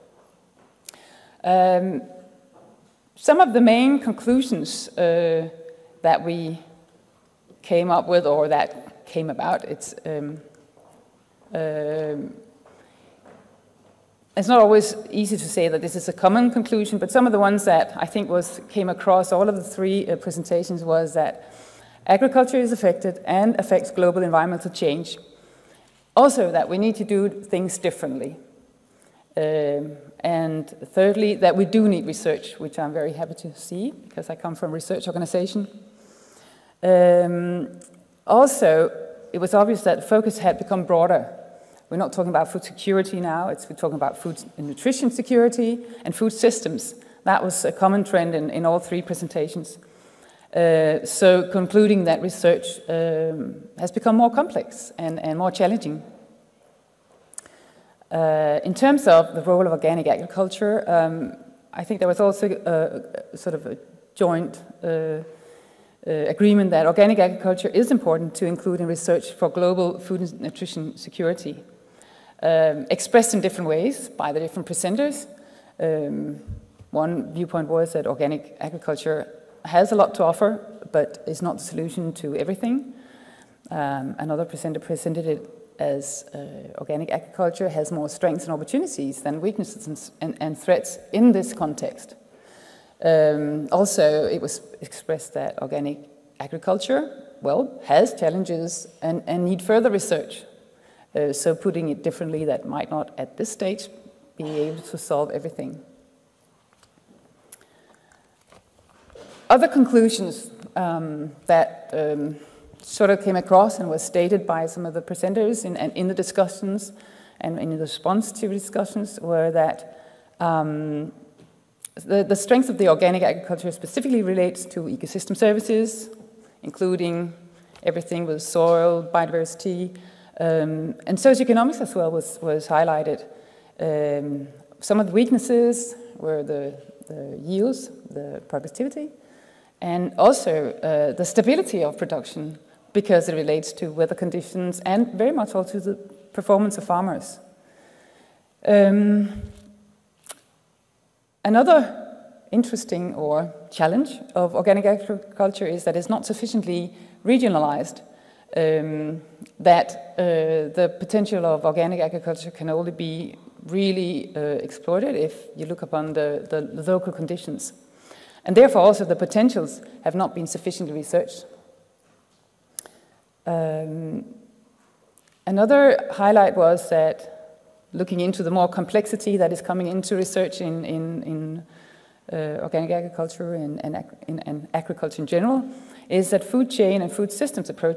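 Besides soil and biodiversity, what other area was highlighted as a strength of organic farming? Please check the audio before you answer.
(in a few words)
socioeconomics.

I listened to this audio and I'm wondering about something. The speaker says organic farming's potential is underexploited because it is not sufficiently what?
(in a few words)
regionalized.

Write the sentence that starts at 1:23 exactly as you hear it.
Um, another presenter presented it as uh, organic agriculture has more strengths and opportunities than weaknesses and, and threats in this context.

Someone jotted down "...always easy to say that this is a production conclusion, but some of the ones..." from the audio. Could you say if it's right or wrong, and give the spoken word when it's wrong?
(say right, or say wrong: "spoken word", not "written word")
wrong: "common", not "production".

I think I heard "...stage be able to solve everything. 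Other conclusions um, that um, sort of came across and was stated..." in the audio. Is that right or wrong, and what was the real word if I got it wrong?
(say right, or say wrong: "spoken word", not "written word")
right.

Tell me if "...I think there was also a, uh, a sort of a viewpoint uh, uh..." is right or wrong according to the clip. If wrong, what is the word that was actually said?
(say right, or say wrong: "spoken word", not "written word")
wrong: "joint", not "viewpoint".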